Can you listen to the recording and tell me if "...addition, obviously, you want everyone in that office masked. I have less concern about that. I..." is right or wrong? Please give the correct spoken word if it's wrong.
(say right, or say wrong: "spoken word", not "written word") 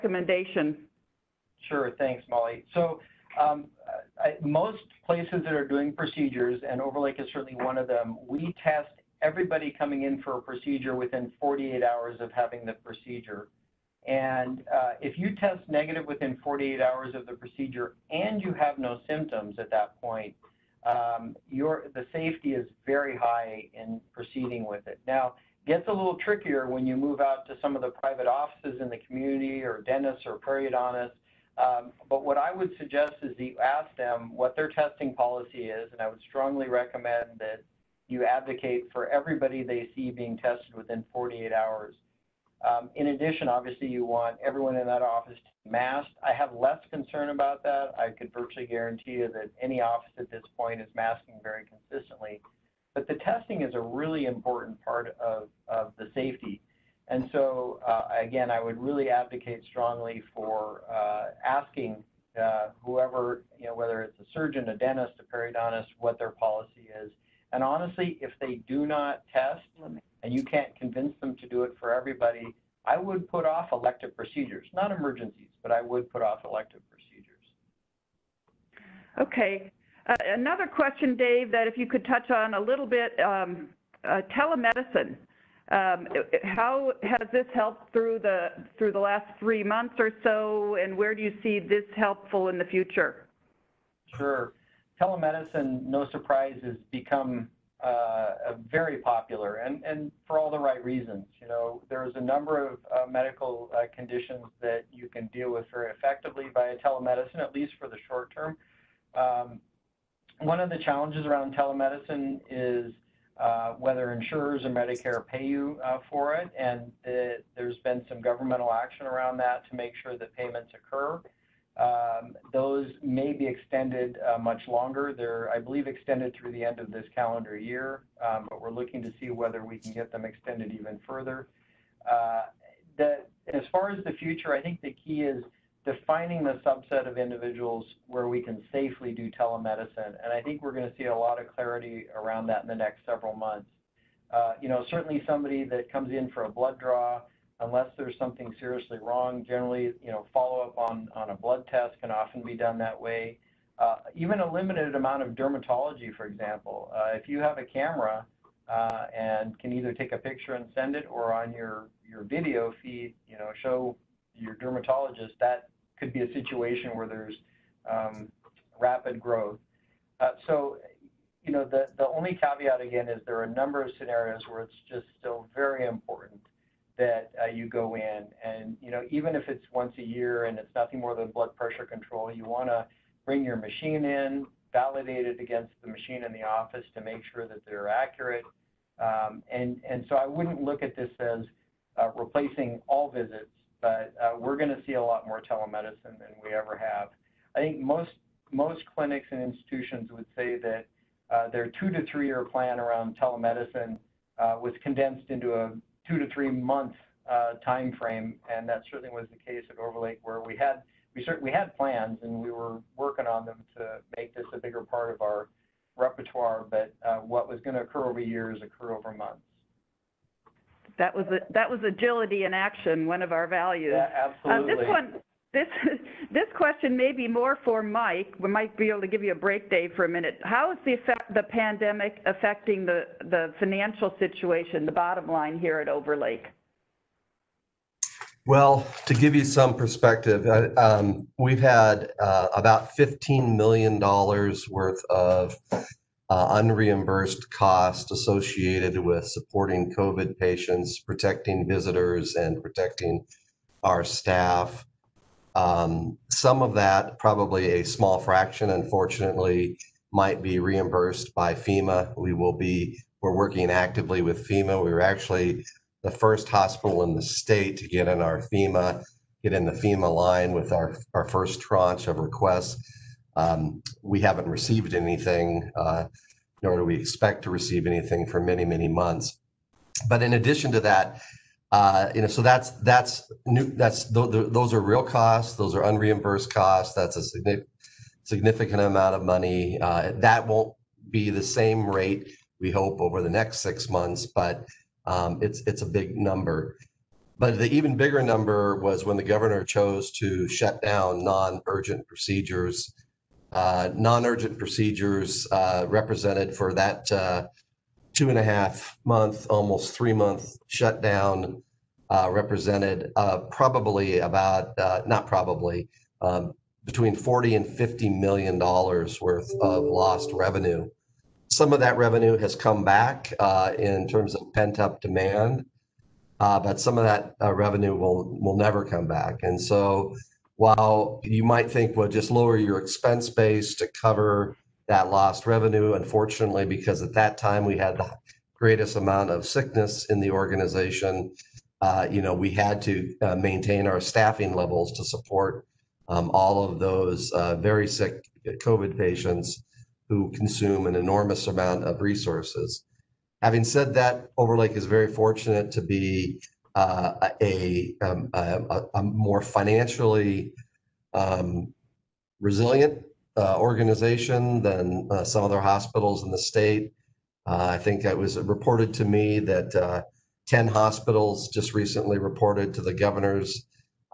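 right.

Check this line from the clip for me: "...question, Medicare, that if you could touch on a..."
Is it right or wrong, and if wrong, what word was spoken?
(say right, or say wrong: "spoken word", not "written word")
wrong: "Dave", not "Medicare".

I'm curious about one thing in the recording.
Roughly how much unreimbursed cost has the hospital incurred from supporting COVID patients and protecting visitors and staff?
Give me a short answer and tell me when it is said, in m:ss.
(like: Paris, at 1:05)
$15 million, at 4:02.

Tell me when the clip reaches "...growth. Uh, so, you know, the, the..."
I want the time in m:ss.
2:49.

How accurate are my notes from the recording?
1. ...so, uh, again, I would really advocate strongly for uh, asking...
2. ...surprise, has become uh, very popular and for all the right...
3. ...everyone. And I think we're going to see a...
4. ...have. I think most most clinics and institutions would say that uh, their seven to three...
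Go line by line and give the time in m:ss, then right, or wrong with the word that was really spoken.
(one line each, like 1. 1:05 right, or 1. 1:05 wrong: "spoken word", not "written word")
1. 0:57 right
2. 1:36 right
3. 2:19 wrong: "telemedicine", not "everyone"
4. 3:16 wrong: "two", not "seven".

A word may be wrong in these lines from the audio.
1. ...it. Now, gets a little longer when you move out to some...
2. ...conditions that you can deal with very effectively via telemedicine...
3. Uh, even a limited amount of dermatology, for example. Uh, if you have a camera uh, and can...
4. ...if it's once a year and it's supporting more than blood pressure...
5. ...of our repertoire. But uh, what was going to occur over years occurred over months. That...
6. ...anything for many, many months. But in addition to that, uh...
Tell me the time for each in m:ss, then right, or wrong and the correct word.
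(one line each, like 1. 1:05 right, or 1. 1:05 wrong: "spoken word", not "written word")
1. 0:24 wrong: "trickier", not "longer"
2. 1:43 right
3. 2:33 right
4. 2:59 wrong: "nothing", not "supporting"
5. 3:35 right
6. 4:37 right.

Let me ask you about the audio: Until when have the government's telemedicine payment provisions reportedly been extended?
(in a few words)
End of this calendar year.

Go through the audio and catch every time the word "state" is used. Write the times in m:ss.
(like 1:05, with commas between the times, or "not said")
4:27, 6:06.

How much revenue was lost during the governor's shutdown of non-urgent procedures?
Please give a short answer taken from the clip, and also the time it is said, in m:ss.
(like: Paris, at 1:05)
$40 to 50 million, at 5:17.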